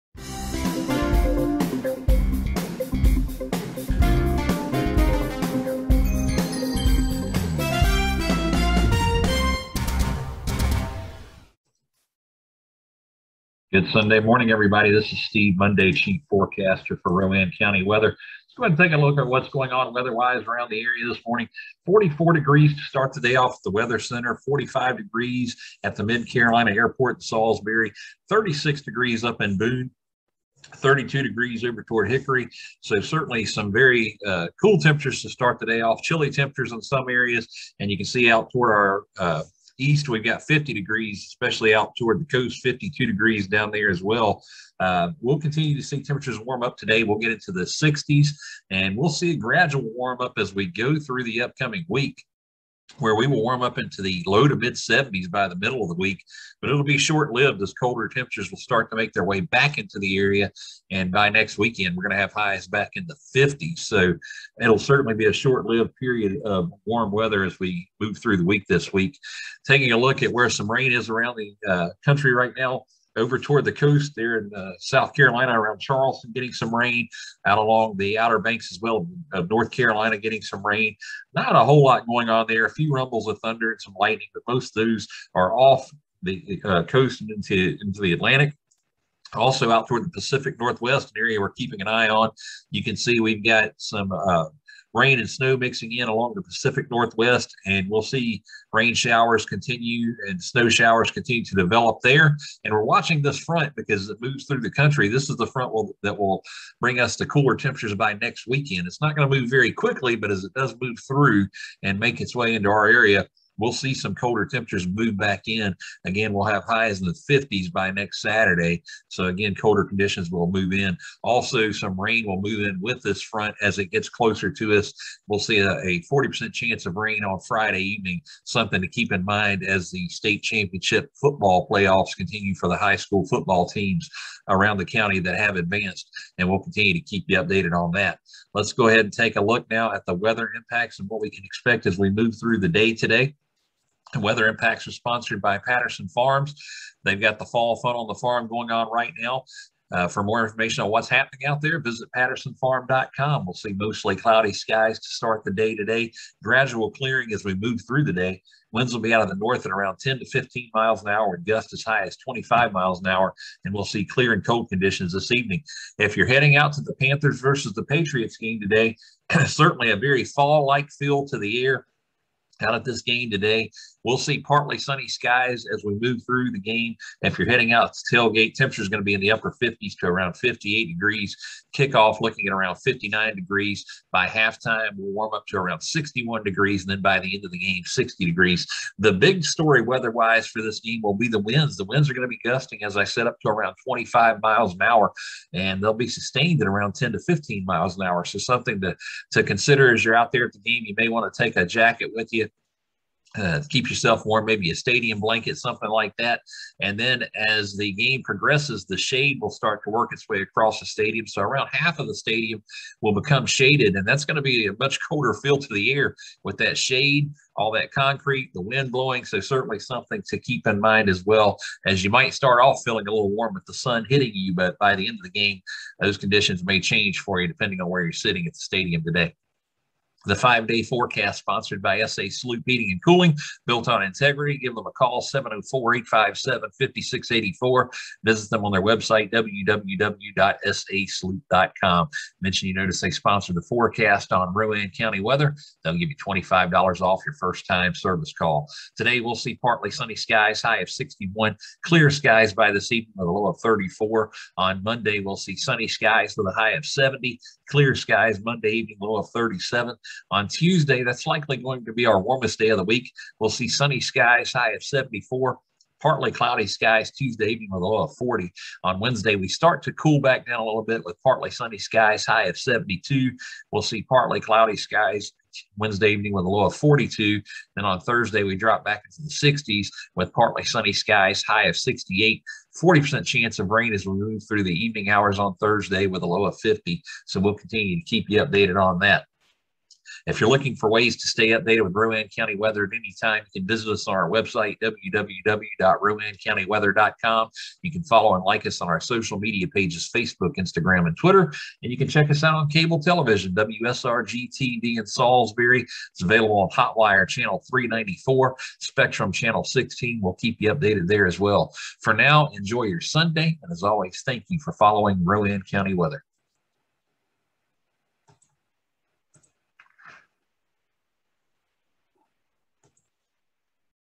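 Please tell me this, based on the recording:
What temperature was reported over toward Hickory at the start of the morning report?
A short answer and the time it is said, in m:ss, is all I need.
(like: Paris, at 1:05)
32 degrees, at 0:30.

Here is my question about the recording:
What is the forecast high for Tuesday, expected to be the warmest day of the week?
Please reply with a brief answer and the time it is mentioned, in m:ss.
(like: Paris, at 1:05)
74, at 4:24.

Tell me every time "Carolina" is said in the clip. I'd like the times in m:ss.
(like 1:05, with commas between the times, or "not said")
0:26, 1:15, 1:19.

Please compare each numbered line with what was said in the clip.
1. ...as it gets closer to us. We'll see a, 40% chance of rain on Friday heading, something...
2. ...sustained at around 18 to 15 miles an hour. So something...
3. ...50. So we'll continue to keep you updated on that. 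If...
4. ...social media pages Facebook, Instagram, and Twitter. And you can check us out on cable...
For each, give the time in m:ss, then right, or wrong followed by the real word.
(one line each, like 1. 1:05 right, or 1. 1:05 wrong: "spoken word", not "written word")
1. 2:03 wrong: "evening", not "heading"
2. 3:16 wrong: "10", not "18"
3. 4:46 right
4. 4:59 right.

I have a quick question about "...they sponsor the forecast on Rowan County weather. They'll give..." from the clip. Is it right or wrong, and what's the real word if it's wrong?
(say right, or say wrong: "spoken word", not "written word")
right.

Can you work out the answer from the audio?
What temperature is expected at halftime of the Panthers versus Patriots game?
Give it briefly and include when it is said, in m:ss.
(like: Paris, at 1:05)
61 degrees, at 3:05.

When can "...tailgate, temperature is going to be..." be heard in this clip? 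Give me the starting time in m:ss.
2:58.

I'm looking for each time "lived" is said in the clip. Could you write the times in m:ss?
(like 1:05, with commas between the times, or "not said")
0:57, 1:05.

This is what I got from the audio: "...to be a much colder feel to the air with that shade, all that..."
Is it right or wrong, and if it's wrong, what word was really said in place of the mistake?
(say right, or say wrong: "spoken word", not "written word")
right.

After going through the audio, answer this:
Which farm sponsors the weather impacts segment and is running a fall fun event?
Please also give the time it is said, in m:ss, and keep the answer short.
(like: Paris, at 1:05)
Patterson Farms, at 2:25.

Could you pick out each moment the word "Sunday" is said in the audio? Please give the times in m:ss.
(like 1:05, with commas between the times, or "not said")
0:13, 5:13.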